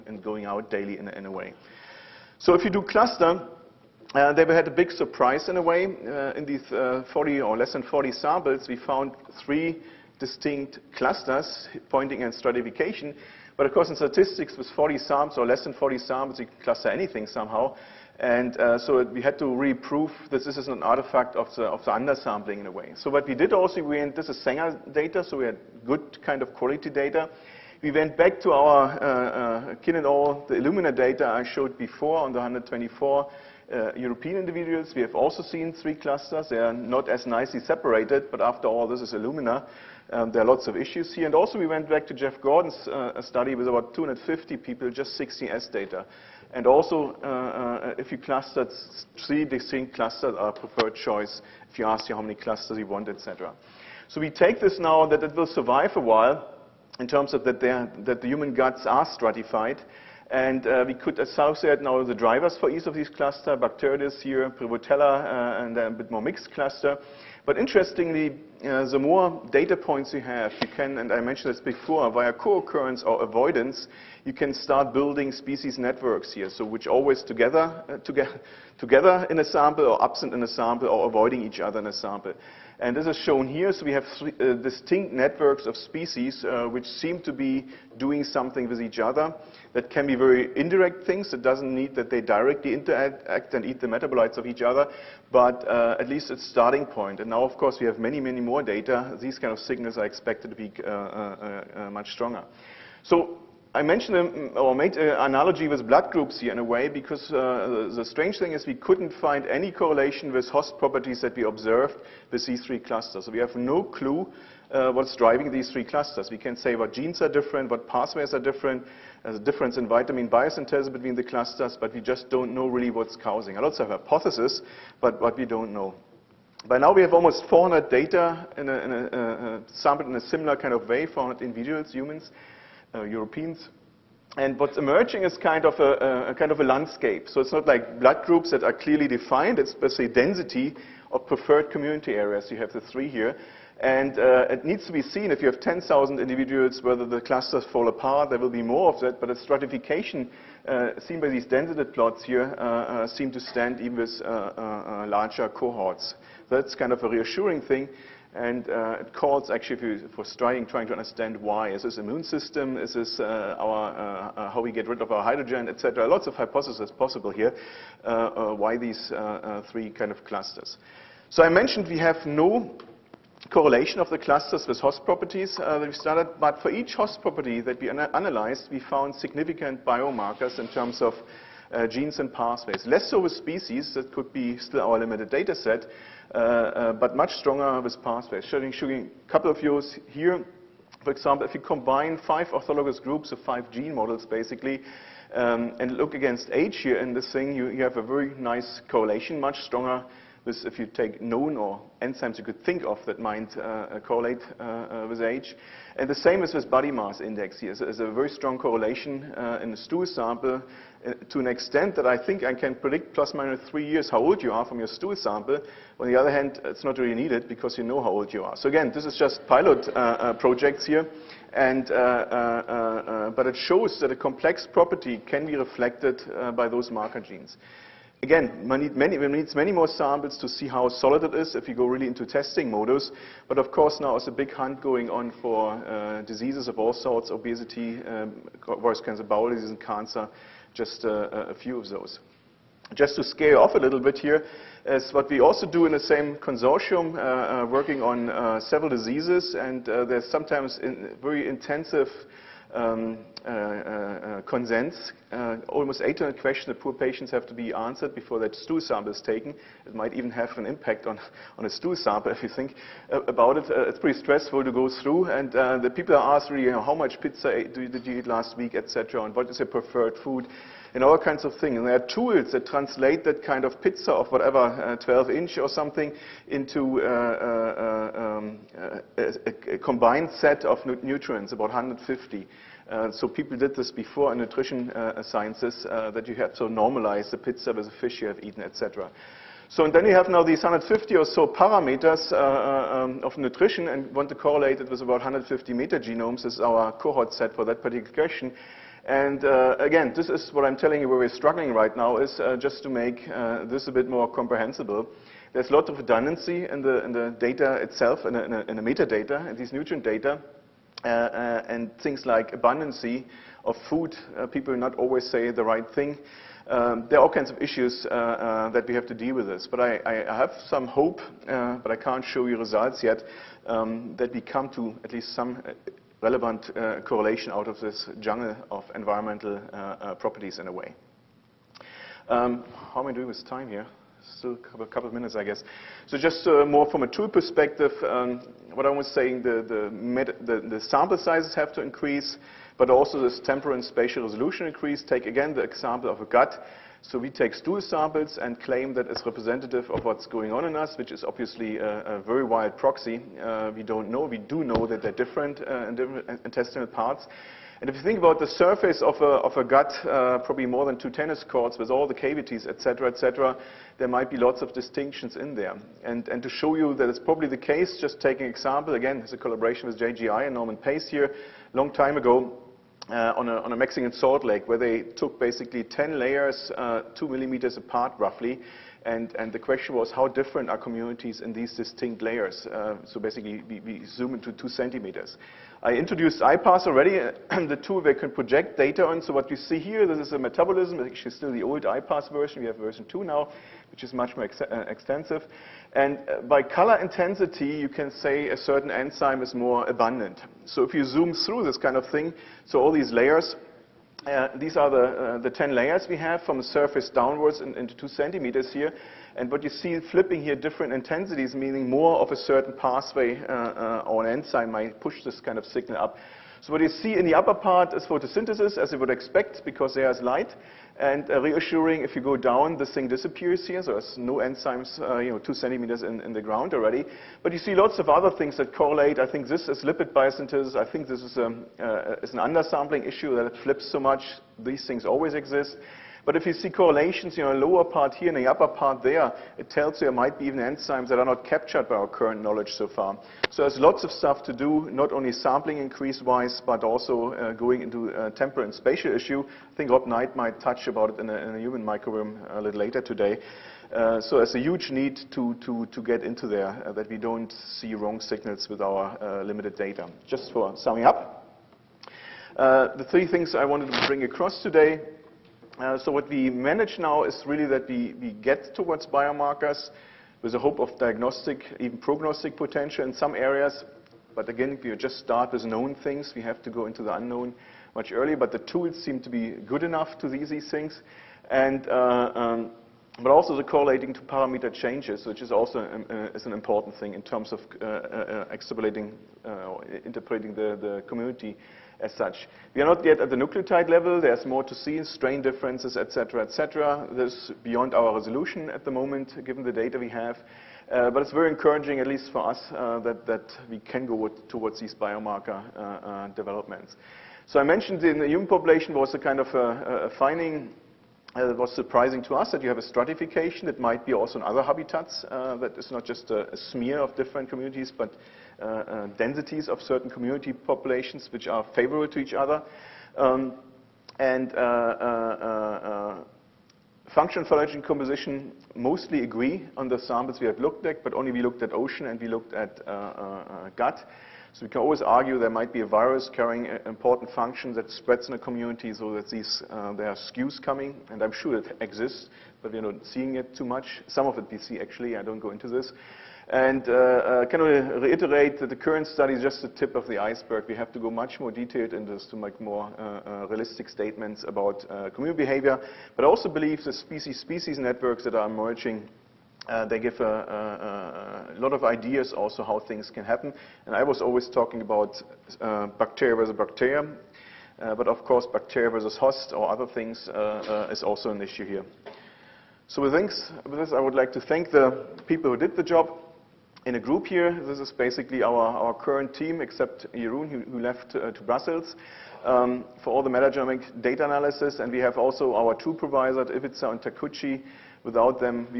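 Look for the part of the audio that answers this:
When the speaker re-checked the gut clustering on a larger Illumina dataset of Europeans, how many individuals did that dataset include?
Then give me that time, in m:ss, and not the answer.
0:32.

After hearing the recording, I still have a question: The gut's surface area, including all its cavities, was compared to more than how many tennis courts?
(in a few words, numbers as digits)
2.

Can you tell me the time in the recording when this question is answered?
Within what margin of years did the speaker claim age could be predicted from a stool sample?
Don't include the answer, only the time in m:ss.
3:33.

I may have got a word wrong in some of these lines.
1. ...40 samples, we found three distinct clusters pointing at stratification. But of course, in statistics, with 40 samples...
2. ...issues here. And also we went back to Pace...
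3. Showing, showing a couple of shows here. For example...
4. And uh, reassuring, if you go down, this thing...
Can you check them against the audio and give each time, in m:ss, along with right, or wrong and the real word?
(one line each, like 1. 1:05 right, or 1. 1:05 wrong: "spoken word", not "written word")
1. 0:07 right
2. 0:40 wrong: "Jeff", not "Pace"
3. 3:08 wrong: "views", not "shows"
4. 7:01 right.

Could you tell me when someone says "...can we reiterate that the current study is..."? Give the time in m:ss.
9:07.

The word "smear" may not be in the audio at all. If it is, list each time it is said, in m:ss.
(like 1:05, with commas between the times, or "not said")
8:36.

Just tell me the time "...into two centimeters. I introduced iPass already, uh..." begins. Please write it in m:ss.
6:24.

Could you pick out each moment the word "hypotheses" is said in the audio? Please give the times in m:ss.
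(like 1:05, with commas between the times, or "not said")
2:04, 2:46.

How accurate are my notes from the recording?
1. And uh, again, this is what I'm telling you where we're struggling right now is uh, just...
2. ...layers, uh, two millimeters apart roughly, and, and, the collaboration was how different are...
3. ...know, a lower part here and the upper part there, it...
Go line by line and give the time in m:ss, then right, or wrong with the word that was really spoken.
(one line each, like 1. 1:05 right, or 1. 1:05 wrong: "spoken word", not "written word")
1. 4:59 right
2. 6:16 wrong: "question", not "collaboration"
3. 7:17 right.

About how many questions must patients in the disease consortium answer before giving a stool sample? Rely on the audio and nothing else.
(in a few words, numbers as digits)
800.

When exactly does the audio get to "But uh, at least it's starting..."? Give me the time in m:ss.
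1:35.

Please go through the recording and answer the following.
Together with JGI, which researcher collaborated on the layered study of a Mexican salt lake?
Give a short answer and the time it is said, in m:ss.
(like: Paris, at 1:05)
Norman Pace, at 6:10.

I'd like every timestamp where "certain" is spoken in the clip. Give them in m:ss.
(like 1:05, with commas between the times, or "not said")
6:38, 6:52, 8:39.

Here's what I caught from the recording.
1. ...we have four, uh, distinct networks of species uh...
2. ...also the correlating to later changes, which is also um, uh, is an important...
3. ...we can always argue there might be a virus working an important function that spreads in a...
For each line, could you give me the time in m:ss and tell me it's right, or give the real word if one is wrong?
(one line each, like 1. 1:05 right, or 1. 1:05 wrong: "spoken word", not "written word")
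1. 1:23 wrong: "three", not "four"
2. 8:03 wrong: "parameter", not "later"
3. 8:54 wrong: "carrying", not "working".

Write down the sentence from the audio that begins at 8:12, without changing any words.
We are not yet at the nucleotide level.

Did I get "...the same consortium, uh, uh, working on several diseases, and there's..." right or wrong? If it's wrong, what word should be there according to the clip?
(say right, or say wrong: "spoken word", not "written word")
right.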